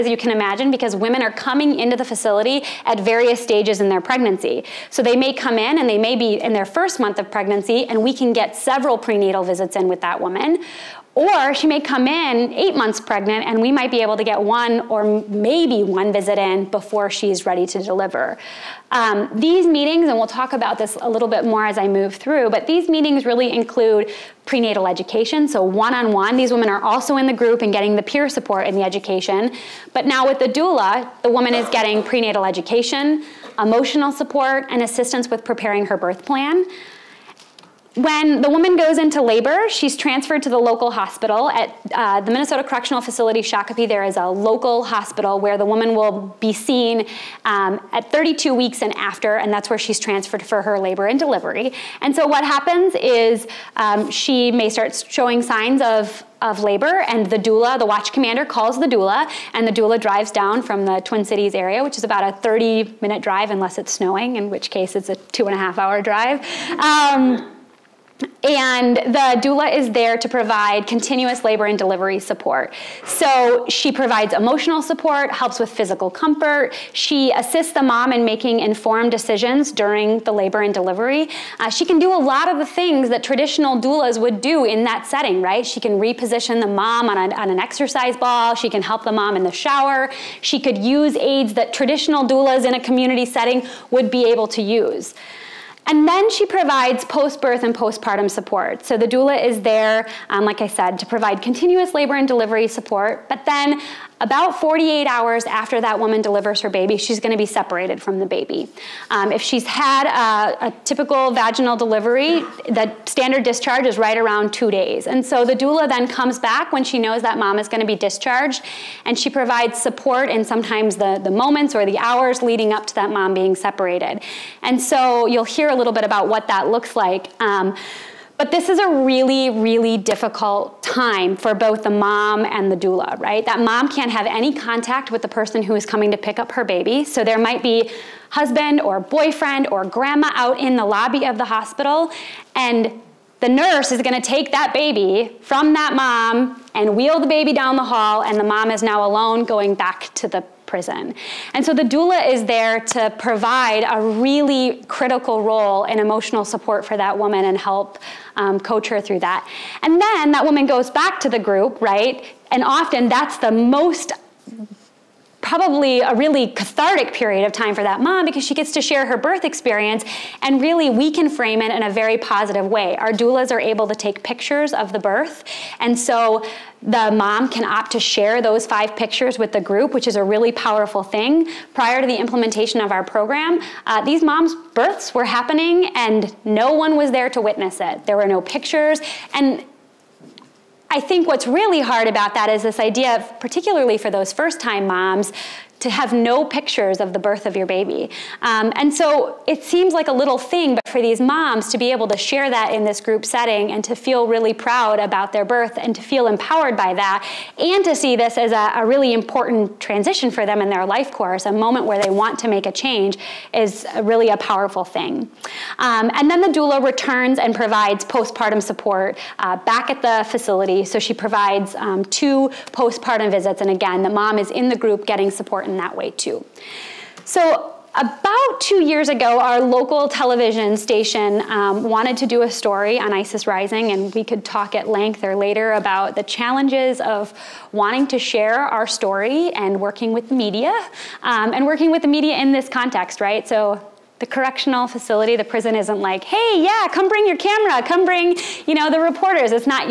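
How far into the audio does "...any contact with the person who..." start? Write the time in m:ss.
2:14.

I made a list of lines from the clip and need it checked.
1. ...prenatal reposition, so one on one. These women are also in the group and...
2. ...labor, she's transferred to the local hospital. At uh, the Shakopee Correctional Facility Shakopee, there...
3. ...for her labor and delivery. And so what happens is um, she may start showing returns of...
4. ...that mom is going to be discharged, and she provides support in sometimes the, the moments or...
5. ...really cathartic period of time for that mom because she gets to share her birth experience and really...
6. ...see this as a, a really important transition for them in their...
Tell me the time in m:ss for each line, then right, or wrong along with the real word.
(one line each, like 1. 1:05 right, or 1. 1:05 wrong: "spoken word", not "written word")
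1. 0:24 wrong: "education", not "reposition"
2. 0:39 wrong: "Minnesota", not "Shakopee"
3. 0:50 wrong: "signs", not "returns"
4. 1:57 right
5. 2:46 right
6. 3:27 right.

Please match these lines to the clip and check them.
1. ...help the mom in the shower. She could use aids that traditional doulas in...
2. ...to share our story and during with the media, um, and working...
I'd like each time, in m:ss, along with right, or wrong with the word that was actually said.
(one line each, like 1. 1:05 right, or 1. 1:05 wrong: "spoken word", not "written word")
1. 1:28 right
2. 3:58 wrong: "working", not "during".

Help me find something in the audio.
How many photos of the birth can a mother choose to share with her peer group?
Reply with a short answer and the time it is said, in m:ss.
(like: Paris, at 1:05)
5, at 2:58.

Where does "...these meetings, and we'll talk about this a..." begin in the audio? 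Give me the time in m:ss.
0:19.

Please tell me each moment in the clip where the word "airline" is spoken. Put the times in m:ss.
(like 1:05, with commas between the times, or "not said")
not said.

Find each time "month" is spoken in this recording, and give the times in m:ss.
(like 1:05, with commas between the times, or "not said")
0:06, 0:12.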